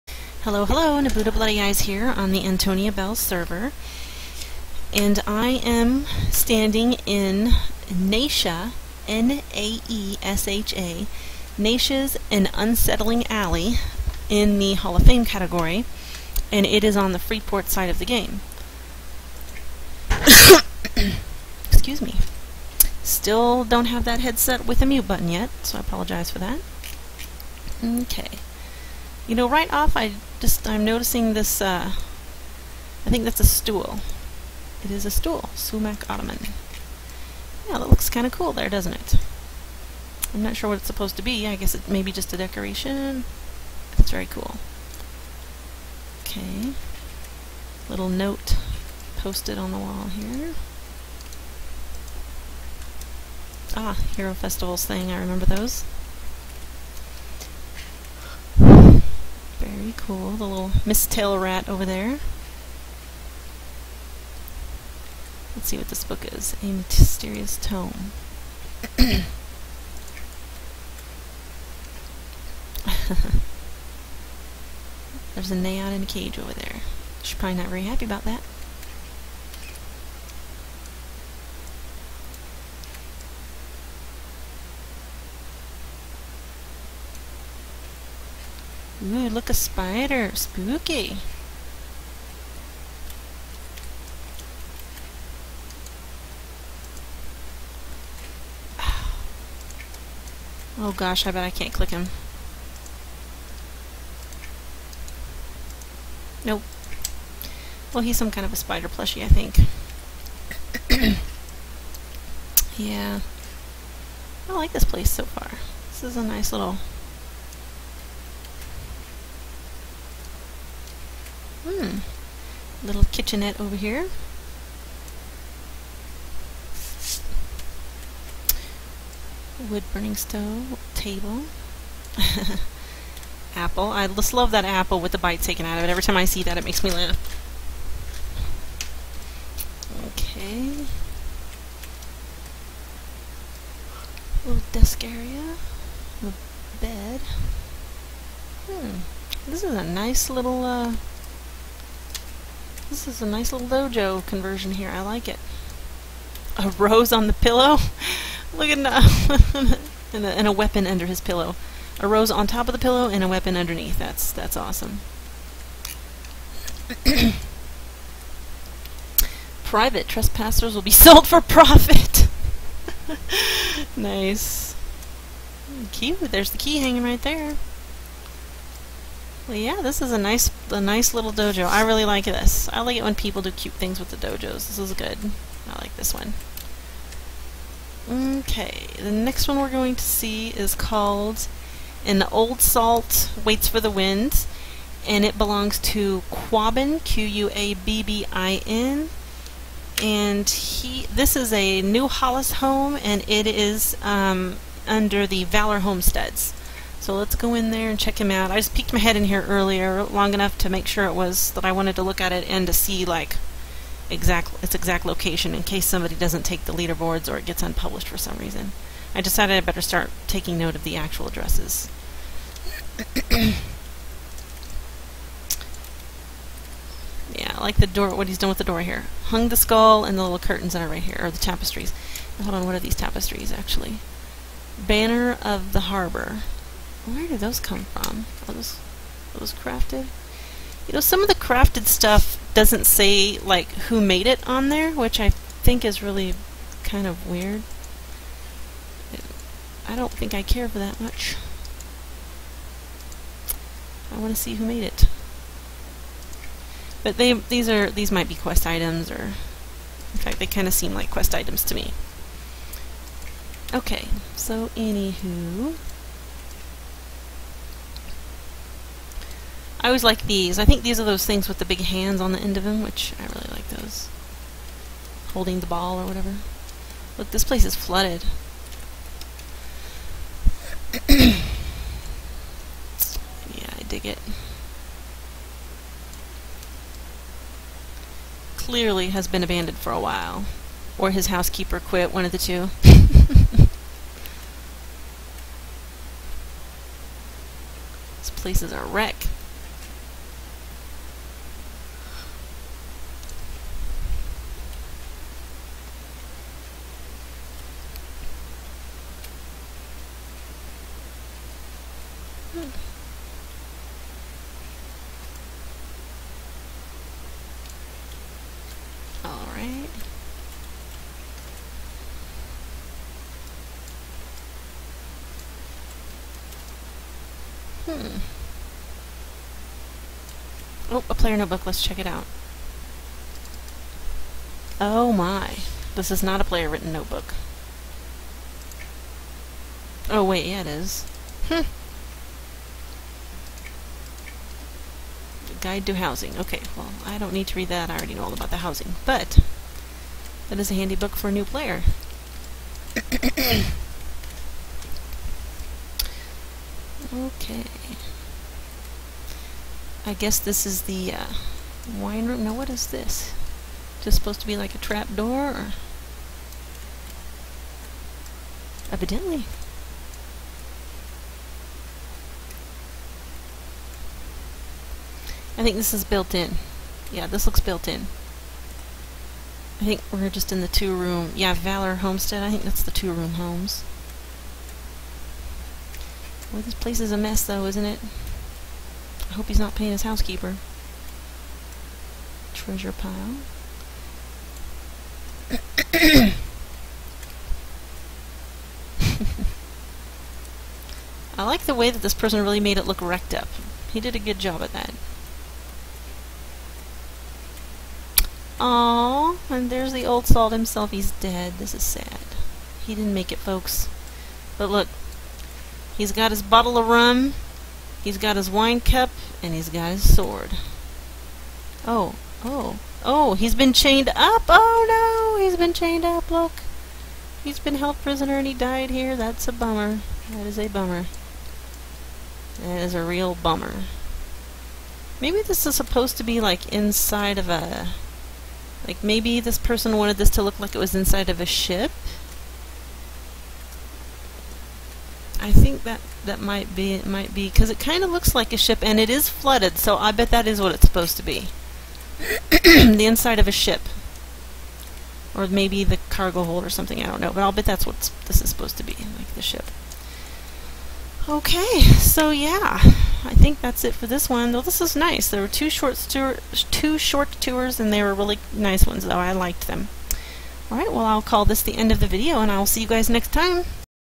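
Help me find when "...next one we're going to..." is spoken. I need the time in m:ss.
3:09.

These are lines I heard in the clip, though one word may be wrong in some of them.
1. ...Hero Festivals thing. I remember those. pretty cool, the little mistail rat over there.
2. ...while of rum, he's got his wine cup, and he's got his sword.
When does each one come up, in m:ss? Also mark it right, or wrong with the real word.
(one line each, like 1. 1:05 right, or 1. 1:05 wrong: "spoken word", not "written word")
1. 0:54 right
2. 6:56 wrong: "bottle", not "while".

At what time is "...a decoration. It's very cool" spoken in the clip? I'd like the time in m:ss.
0:42.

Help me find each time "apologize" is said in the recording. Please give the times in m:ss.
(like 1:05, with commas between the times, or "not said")
0:25.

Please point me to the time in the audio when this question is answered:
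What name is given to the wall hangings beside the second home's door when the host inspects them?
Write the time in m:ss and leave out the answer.
3:54.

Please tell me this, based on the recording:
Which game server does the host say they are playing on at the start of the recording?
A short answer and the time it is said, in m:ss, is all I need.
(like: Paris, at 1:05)
Antonia Bayle, at 0:02.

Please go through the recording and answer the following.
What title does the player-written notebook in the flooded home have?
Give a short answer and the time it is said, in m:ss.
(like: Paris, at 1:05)
Guide to Housing, at 5:45.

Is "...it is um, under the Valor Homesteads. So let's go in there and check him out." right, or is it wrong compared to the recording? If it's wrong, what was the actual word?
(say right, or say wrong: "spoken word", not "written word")
right.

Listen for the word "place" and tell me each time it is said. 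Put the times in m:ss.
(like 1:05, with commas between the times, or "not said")
1:54, 4:37, 4:58, 6:26.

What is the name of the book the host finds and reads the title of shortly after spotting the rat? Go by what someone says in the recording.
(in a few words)
A Mysterious Tome.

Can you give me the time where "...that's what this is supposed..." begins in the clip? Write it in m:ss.
7:37.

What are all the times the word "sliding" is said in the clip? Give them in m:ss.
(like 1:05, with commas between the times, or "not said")
not said.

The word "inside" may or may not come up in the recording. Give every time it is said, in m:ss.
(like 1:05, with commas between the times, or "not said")
7:16, 7:20, 7:33.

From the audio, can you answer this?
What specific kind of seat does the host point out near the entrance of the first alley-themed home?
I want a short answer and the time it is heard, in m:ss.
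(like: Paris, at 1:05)
Sumac ottoman, at 0:35.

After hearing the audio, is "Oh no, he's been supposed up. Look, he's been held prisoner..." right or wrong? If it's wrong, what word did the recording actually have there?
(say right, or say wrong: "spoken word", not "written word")
wrong: "chained", not "supposed".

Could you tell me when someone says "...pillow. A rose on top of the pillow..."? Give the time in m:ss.
2:41.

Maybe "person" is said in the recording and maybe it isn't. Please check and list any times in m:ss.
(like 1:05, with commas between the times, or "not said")
6:42, 7:19.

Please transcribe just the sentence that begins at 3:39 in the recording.
I decided I better start taking note of the actual addresses.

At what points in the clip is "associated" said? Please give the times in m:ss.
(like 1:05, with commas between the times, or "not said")
not said.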